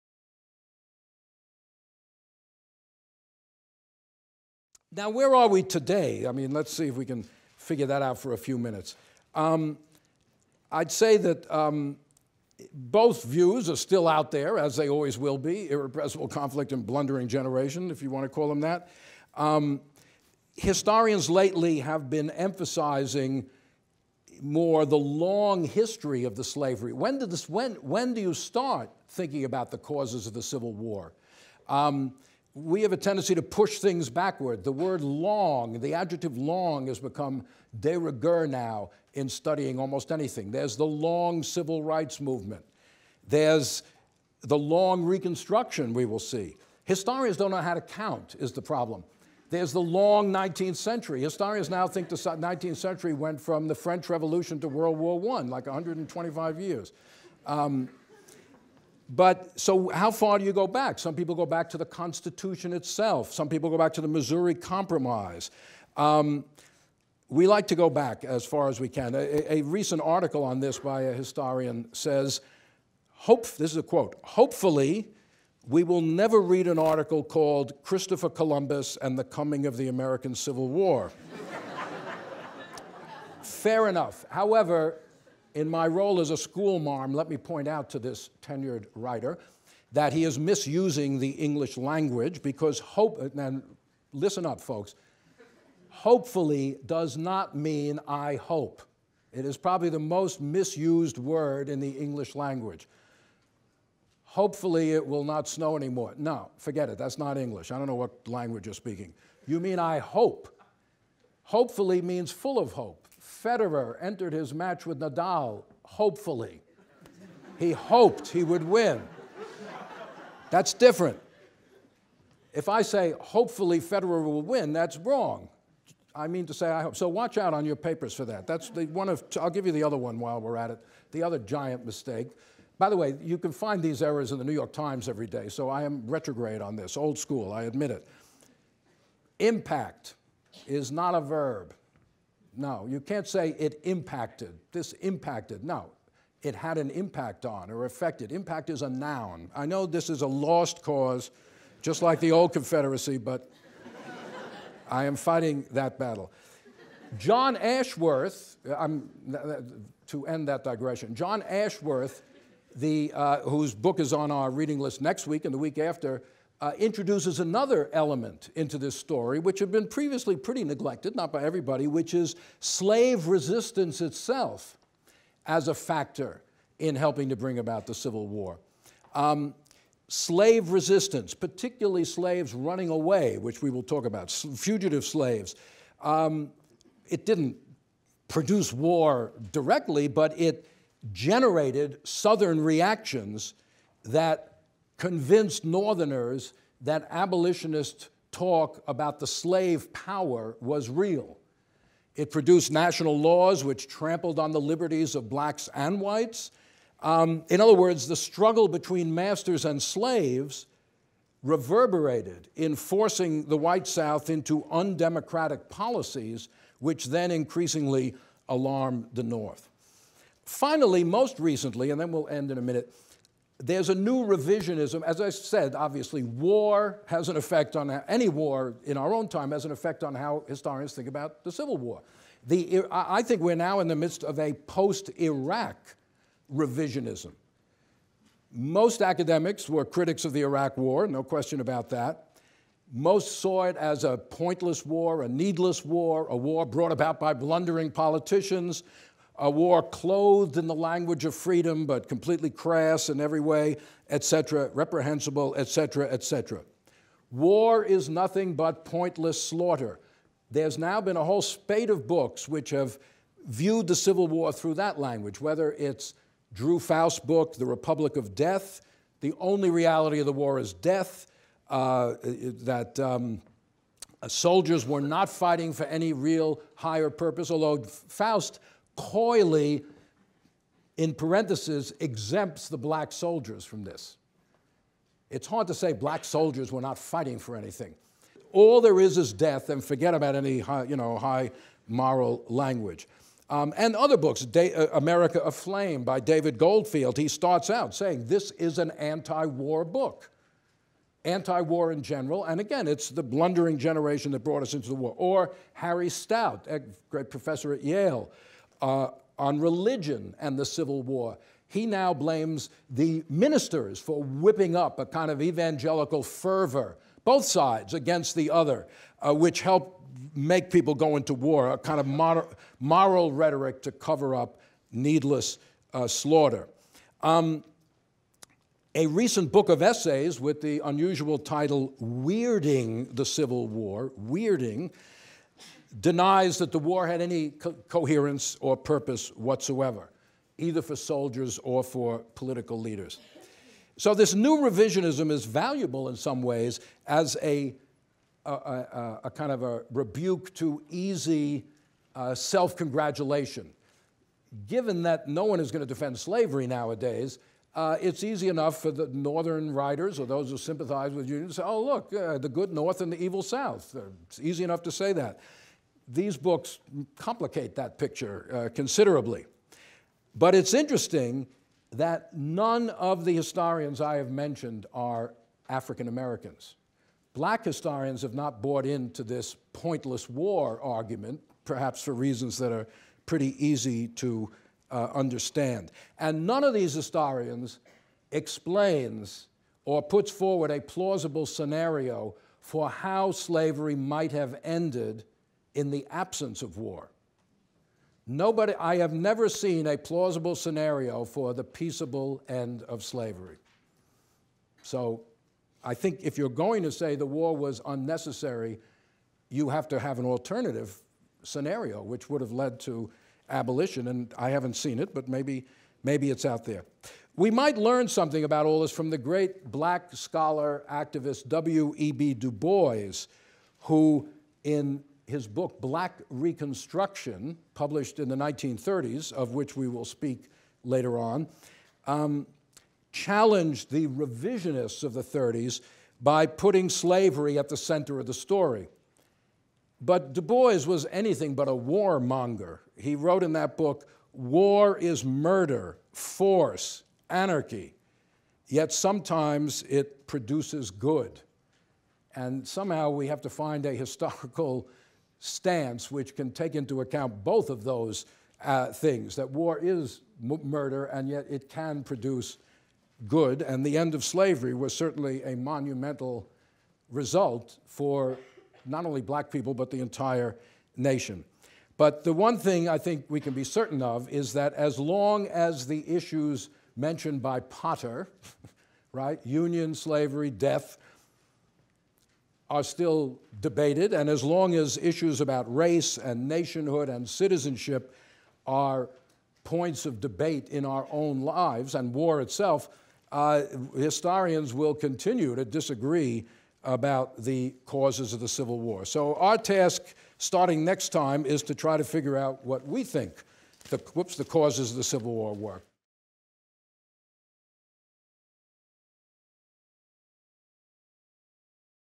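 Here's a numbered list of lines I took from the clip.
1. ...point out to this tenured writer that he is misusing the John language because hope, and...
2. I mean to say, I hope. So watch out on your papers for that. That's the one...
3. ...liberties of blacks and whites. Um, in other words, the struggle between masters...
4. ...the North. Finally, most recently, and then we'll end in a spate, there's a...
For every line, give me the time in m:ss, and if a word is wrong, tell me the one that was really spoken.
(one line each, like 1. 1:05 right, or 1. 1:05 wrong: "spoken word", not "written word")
1. 1:27 wrong: "English", not "John"
2. 2:06 right
3. 3:24 right
4. 3:39 wrong: "minute", not "spate".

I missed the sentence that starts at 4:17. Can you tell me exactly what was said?
War is nothing but pointless slaughter.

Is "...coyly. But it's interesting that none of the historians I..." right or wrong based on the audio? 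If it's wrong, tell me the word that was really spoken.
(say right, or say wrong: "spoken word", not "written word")
wrong: "considerably", not "coyly".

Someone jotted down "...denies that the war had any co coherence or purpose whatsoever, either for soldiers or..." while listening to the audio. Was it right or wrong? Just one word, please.
right.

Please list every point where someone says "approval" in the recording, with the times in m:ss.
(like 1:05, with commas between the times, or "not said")
not said.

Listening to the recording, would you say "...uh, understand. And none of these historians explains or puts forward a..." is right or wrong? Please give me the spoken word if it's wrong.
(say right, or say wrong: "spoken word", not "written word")
right.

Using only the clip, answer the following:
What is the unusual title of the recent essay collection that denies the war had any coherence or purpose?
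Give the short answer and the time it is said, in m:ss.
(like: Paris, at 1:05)
Weirding the Civil War, at 5:32.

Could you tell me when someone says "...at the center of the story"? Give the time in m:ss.
7:17.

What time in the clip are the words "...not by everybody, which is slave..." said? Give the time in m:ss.
2:51.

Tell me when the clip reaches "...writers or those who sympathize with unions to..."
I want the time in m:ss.
5:59.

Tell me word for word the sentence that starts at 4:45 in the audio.
It's hard to say black soldiers were not fighting for anything.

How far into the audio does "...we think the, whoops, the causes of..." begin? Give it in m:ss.
8:22.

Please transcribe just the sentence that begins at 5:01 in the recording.
Anti war in general, and again, it's the blundering generation that brought us into the war.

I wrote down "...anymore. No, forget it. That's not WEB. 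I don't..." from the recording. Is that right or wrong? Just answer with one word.
wrong.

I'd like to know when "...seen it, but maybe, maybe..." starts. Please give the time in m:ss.
6:54.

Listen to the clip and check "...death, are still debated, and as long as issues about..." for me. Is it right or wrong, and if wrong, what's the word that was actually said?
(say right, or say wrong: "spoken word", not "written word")
right.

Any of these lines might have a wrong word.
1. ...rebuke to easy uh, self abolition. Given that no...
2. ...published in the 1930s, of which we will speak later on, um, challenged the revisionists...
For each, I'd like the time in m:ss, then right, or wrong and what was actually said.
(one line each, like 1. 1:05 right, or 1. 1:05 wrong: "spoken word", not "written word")
1. 5:49 wrong: "congratulation", not "abolition"
2. 7:07 right.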